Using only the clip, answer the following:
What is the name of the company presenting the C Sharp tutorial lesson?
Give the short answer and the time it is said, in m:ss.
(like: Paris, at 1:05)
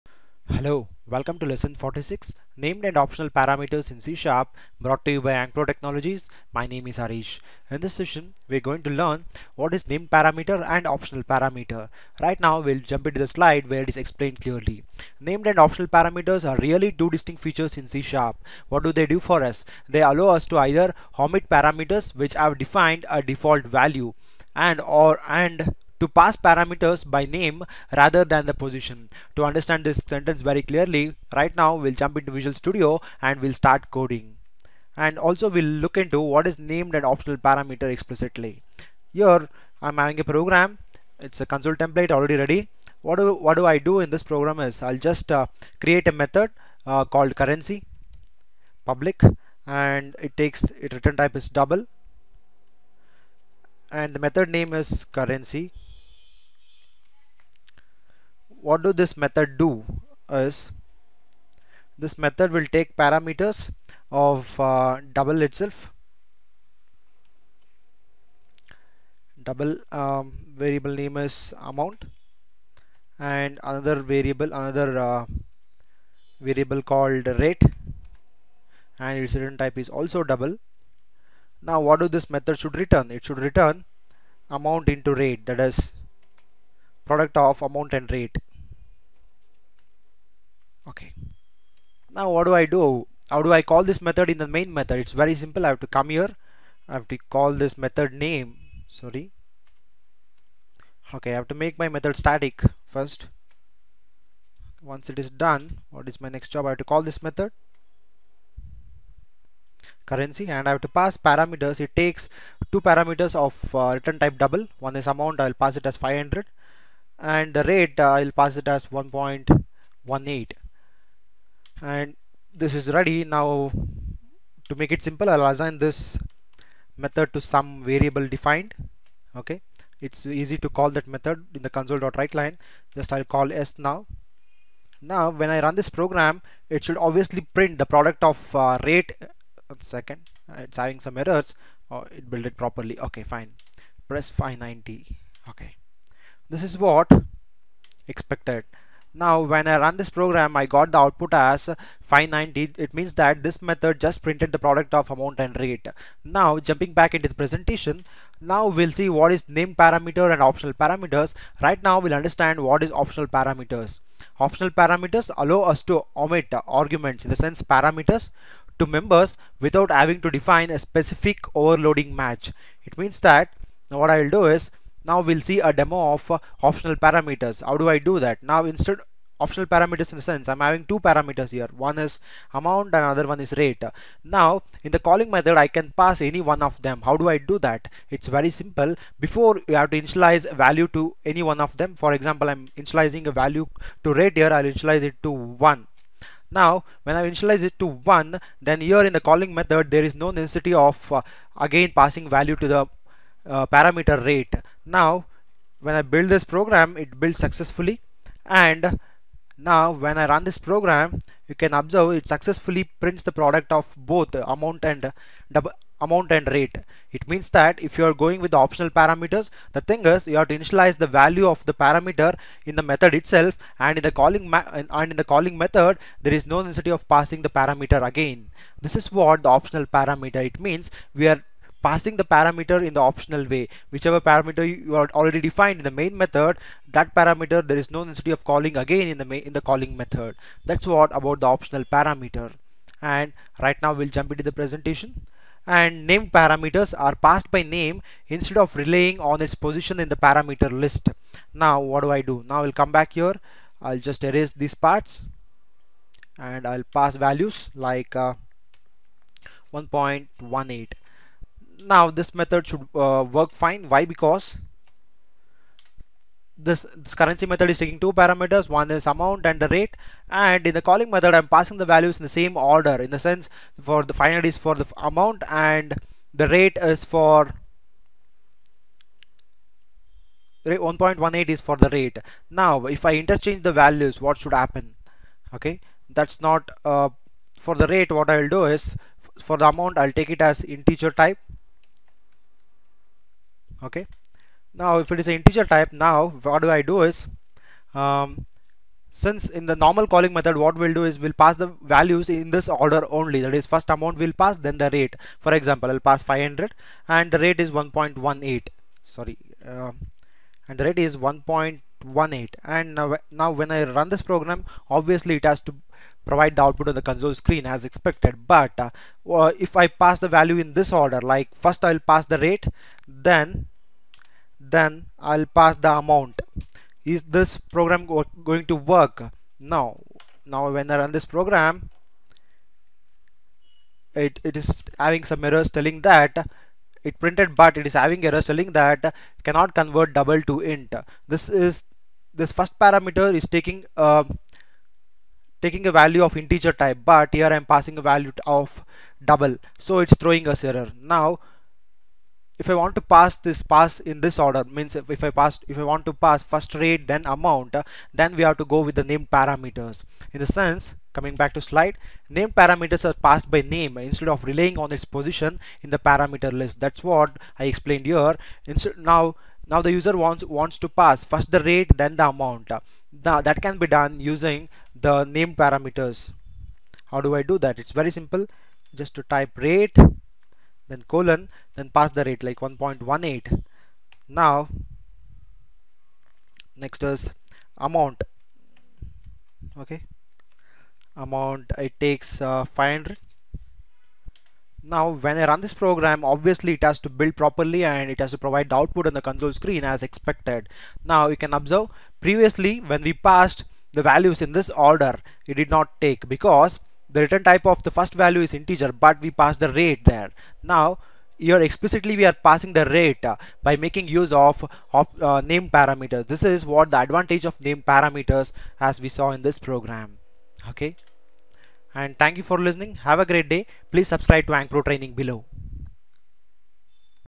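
Ankpro Technologies, at 0:05.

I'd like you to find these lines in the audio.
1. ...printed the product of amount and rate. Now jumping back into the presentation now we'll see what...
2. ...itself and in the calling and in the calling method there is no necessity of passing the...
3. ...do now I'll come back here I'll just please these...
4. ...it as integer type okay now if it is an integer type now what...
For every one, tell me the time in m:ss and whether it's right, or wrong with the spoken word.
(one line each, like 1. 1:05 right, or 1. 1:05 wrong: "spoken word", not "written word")
1. 2:34 right
2. 3:43 right
3. 4:12 wrong: "erase", not "please"
4. 4:50 right.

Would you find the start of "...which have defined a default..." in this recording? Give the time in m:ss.
0:22.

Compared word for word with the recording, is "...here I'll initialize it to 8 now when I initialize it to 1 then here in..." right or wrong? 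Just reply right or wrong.
wrong.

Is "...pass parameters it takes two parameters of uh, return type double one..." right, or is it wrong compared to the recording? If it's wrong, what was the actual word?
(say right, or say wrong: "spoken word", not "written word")
right.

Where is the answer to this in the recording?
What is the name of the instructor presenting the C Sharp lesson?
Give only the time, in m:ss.
0:06.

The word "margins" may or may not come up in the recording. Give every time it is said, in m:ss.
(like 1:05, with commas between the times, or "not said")
not said.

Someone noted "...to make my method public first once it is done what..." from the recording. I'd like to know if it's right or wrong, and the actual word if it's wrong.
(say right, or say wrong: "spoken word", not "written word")
wrong: "static", not "public".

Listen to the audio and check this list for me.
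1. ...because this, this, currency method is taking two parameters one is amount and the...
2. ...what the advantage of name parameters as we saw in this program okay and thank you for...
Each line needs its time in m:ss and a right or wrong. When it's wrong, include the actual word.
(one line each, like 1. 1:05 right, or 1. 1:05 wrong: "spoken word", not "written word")
1. 4:24 right
2. 6:56 right.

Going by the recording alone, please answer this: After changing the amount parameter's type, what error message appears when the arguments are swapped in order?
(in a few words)
cannot convert double to int.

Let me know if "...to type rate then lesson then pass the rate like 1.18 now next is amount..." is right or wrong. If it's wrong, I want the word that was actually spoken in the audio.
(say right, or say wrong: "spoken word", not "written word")
wrong: "colon", not "lesson".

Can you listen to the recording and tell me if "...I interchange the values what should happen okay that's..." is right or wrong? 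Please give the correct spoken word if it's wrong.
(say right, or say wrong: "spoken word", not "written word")
right.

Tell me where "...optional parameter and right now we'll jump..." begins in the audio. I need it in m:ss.
4:01.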